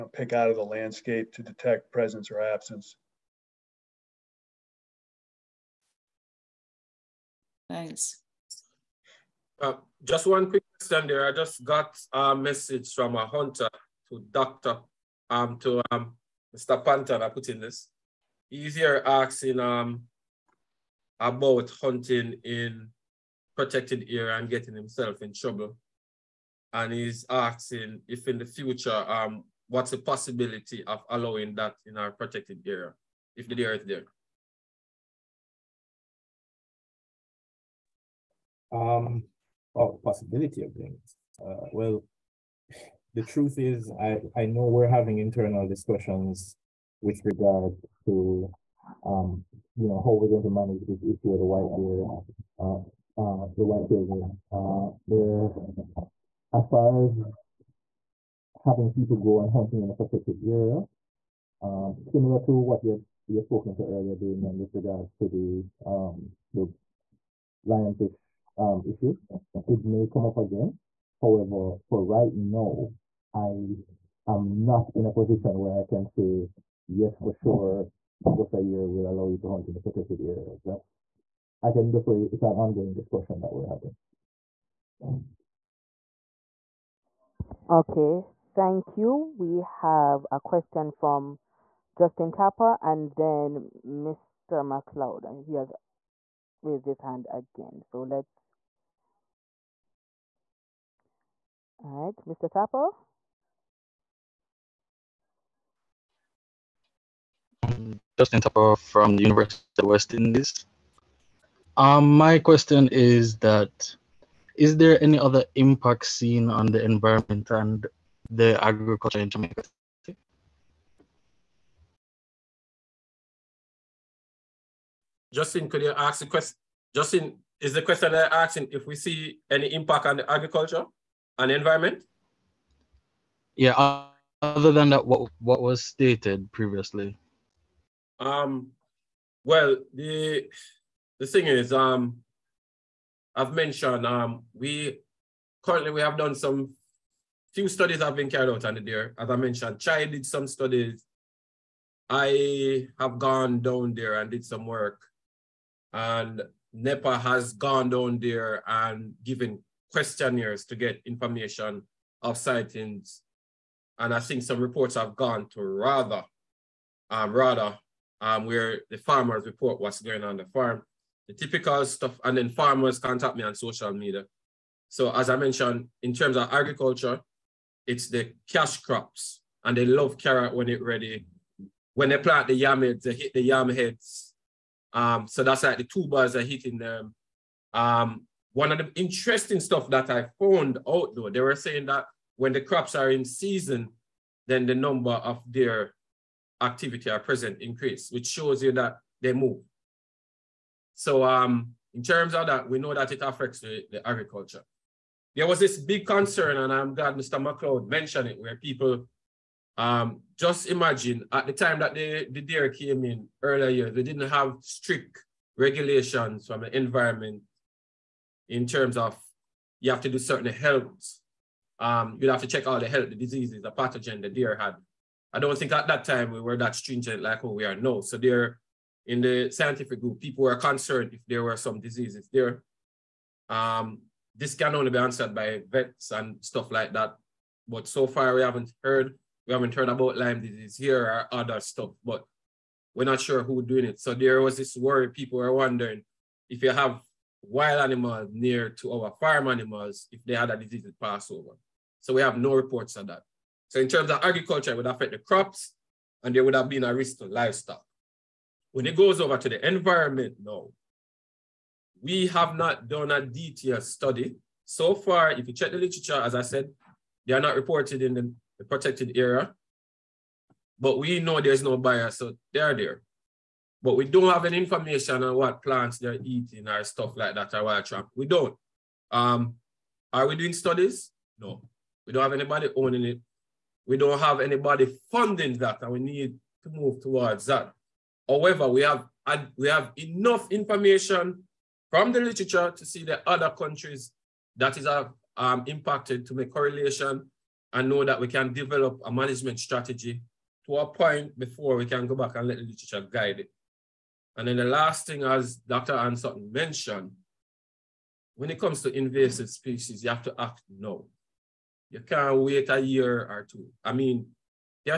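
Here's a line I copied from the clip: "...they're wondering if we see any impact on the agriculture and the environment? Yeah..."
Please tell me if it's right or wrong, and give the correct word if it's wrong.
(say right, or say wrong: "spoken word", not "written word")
wrong: "asking", not "wondering".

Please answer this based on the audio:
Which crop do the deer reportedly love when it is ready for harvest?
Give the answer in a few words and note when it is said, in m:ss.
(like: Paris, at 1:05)
carrot, at 3:00.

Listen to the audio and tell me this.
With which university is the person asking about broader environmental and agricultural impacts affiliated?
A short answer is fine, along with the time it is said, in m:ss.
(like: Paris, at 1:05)
University of the West Indies, at 1:49.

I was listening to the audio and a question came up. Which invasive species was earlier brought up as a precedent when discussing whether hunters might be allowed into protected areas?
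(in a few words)
lionfish.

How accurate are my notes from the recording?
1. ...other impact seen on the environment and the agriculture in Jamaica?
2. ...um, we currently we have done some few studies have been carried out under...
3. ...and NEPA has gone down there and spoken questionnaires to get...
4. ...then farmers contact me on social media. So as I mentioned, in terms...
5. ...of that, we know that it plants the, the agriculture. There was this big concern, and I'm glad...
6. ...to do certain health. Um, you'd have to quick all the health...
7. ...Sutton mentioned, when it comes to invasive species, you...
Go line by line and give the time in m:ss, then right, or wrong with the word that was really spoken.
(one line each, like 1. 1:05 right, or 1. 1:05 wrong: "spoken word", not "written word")
1. 1:55 right
2. 2:24 right
3. 2:35 wrong: "given", not "spoken"
4. 2:52 right
5. 3:22 wrong: "affects", not "plants"
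6. 3:40 wrong: "check", not "quick"
7. 5:06 right.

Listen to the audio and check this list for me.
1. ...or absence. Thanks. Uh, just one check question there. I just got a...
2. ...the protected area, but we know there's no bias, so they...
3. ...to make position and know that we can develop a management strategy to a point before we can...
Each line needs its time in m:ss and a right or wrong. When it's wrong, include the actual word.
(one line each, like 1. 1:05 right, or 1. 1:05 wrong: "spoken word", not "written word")
1. 0:02 wrong: "quick", not "check"
2. 4:28 right
3. 4:56 wrong: "correlation", not "position".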